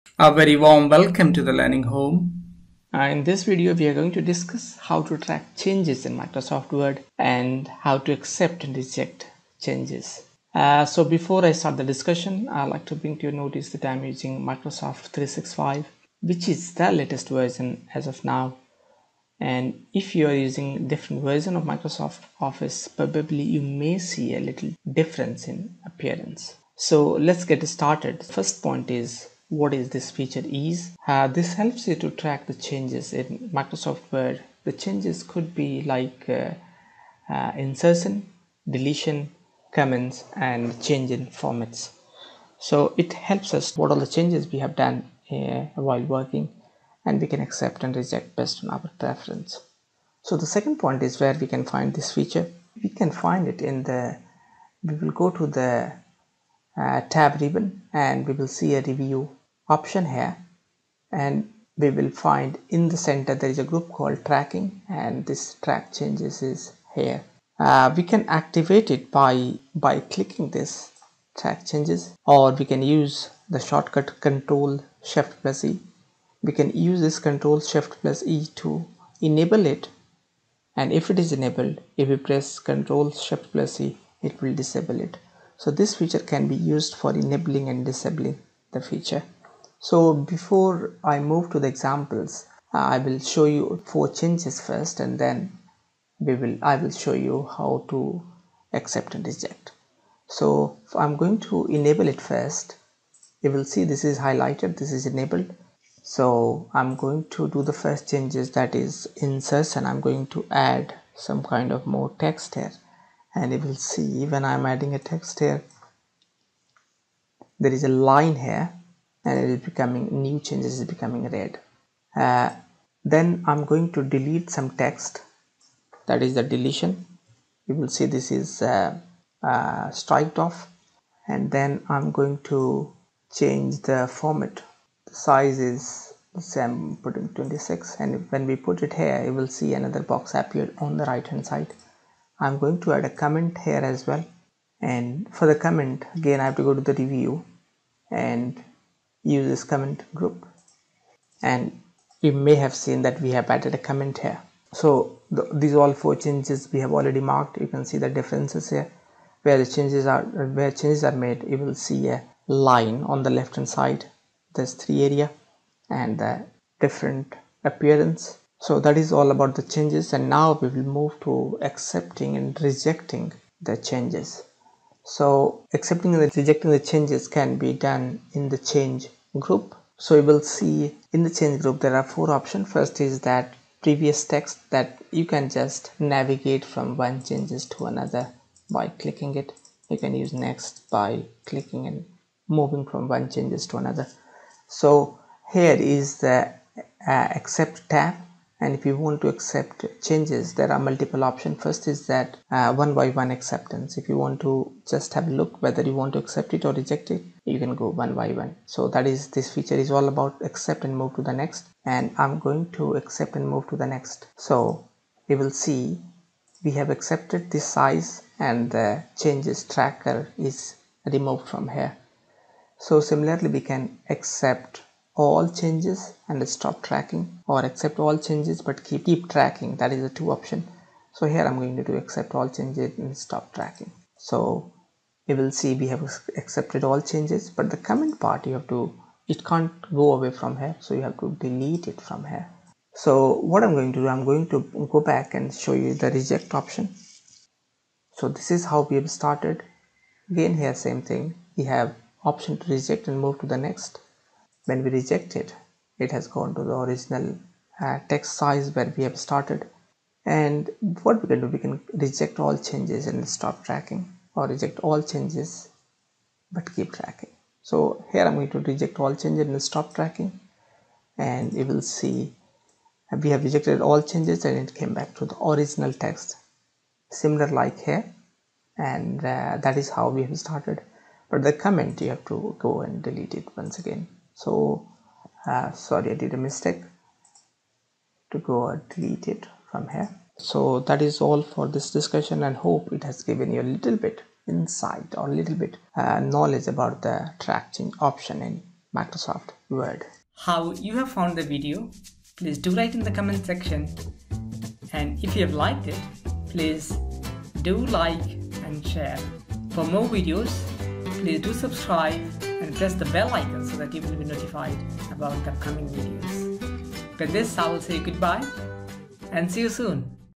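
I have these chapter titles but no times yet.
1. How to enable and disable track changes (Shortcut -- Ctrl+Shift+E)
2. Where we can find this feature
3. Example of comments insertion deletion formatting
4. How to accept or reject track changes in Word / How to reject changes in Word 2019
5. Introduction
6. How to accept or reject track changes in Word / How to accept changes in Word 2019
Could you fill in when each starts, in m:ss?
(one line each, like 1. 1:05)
1. 1:15
2. 0:55
3. 1:55
4. 4:22
5. 0:30
6. 2:55.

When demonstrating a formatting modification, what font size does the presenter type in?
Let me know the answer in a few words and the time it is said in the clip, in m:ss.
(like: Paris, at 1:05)
26, at 2:17.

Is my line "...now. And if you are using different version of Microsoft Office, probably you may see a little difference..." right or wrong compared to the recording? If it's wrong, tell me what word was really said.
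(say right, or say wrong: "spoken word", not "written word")
right.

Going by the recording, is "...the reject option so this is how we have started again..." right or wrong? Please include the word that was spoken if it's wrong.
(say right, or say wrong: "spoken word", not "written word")
right.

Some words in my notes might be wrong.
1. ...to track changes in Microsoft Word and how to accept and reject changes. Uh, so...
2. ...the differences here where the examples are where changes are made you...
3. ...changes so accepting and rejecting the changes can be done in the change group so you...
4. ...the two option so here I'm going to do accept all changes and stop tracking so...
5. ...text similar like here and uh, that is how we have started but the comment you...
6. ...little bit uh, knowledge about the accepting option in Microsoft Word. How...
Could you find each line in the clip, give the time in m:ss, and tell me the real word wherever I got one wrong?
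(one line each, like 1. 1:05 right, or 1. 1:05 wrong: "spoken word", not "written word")
1. 0:05 right
2. 2:37 wrong: "changes", not "examples"
3. 2:53 right
4. 3:50 right
5. 4:36 right
6. 4:55 wrong: "tracking", not "accepting".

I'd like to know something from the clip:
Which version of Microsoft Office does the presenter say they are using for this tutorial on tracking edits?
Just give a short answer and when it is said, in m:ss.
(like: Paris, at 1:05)
Microsoft 365, at 0:14.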